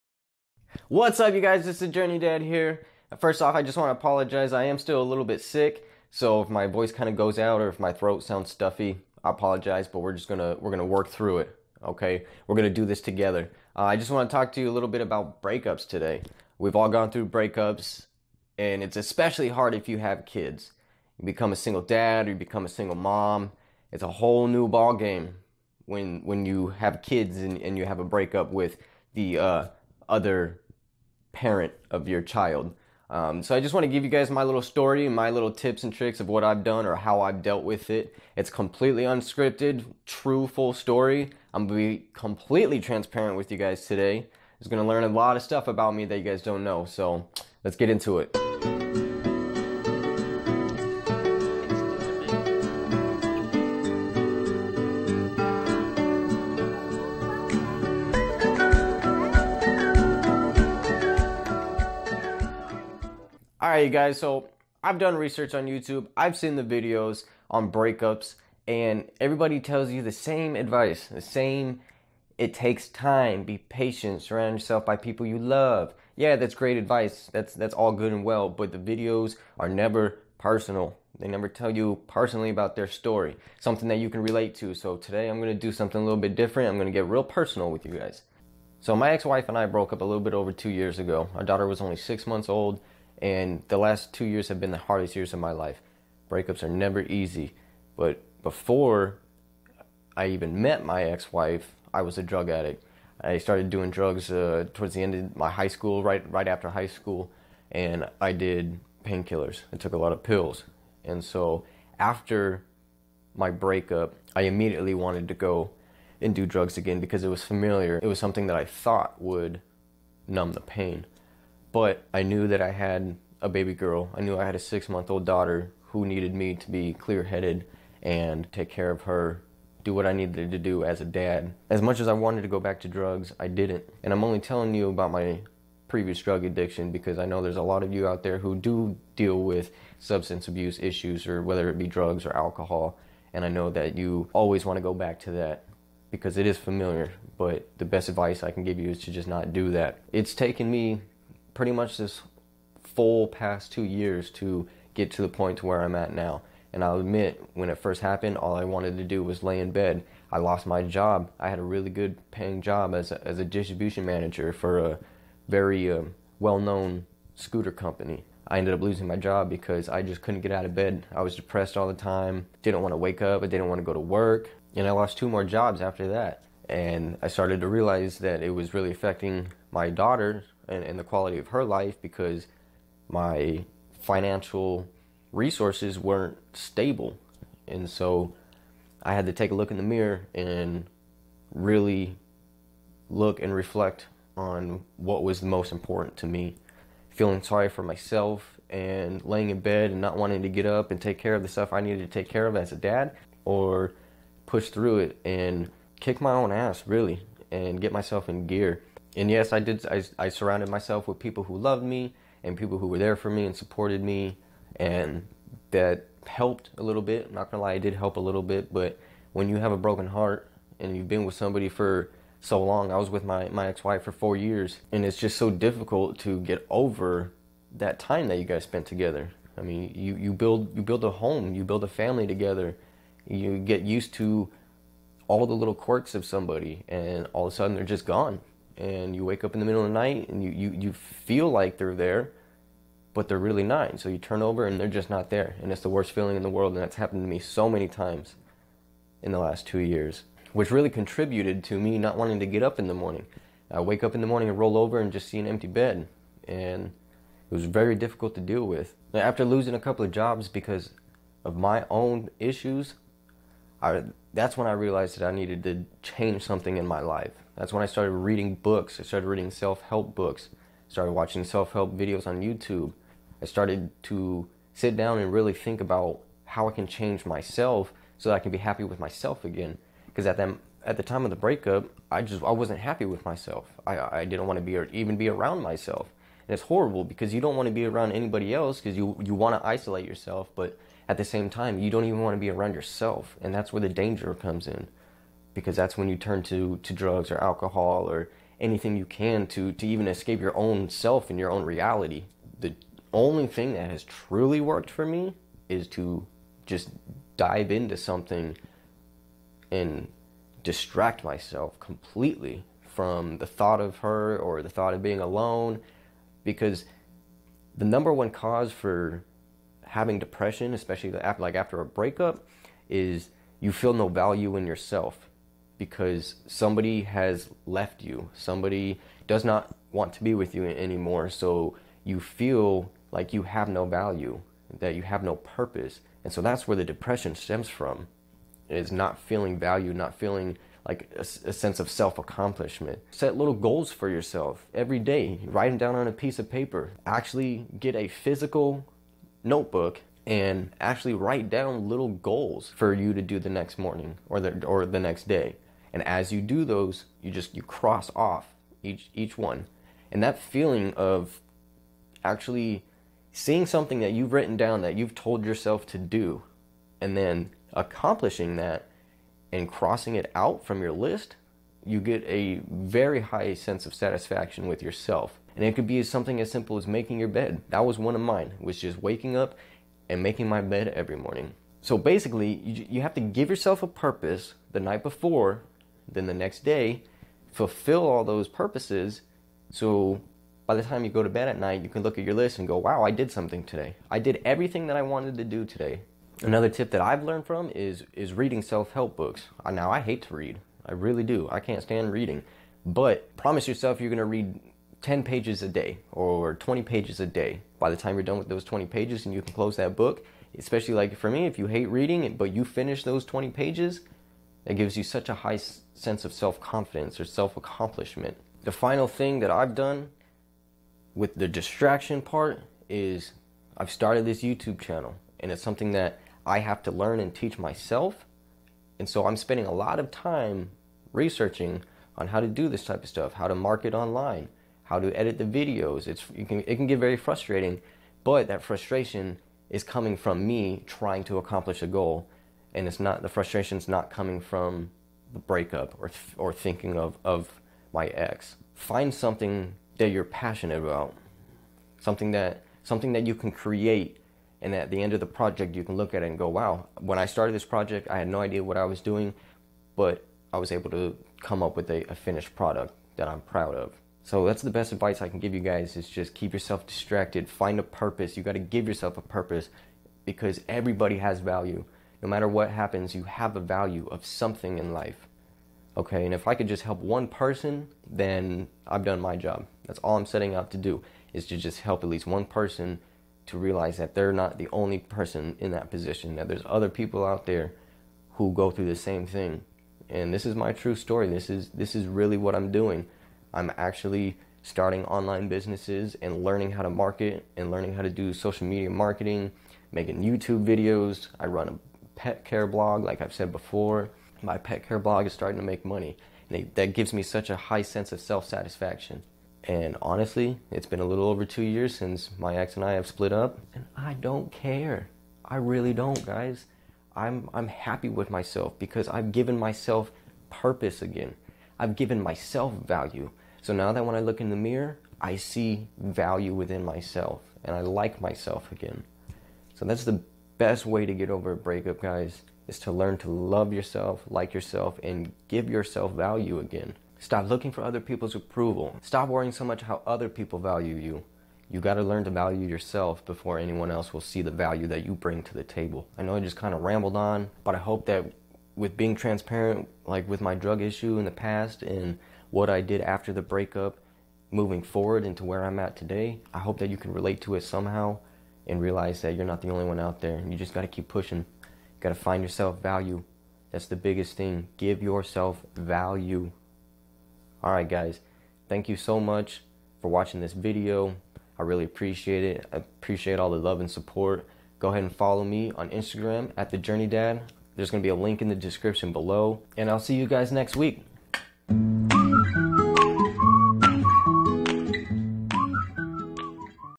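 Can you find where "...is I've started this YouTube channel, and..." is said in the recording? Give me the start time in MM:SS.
07:02.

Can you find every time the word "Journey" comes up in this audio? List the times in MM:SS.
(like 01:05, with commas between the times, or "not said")
00:01, 09:36.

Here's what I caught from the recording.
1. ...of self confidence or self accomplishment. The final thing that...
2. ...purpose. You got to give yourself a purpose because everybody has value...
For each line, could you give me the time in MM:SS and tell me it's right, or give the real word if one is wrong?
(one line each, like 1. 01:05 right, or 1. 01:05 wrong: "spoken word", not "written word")
1. 06:56 right
2. 07:47 right.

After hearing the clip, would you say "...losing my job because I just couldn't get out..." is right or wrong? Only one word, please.
right.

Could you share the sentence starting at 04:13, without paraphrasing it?
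I wake up in the morning and roll over and just see an empty bed.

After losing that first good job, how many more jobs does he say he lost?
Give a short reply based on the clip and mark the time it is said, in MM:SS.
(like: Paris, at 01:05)
2, at 02:55.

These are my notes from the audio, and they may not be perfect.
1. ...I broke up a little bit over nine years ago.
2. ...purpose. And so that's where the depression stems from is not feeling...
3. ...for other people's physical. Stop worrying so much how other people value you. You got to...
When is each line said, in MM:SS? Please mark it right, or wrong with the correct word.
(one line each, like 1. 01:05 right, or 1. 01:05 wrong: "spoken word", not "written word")
1. 01:29 wrong: "two", not "nine"
2. 05:35 right
3. 08:57 wrong: "approval", not "physical".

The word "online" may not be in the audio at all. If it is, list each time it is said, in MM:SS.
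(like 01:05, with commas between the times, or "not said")
07:13, 08:15.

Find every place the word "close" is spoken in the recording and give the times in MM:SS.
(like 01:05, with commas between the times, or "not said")
06:49.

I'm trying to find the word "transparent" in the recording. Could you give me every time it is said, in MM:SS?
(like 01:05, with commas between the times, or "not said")
00:42, 09:09.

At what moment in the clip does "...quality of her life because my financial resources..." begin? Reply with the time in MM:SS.
03:01.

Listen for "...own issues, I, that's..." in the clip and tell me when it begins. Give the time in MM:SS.
04:21.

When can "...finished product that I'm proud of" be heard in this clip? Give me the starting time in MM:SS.
07:42.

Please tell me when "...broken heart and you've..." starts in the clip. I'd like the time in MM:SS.
03:39.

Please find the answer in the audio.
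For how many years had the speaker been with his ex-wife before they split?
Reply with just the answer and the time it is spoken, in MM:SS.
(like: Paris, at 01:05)
4 years, at 03:44.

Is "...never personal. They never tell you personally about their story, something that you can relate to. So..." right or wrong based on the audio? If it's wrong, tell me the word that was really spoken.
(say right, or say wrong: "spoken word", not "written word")
right.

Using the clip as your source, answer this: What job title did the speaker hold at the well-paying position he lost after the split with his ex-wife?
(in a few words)
Distribution manager.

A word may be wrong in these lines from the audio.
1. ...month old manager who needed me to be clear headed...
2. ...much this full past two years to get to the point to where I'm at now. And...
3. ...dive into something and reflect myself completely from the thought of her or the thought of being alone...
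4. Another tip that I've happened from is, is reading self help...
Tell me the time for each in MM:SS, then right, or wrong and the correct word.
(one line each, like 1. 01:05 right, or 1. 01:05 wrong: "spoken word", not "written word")
1. 02:04 wrong: "daughter", not "manager"
2. 02:31 right
3. 05:07 wrong: "distract", not "reflect"
4. 06:36 wrong: "learned", not "happened".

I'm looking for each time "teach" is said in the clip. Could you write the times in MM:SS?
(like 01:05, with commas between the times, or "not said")
07:07.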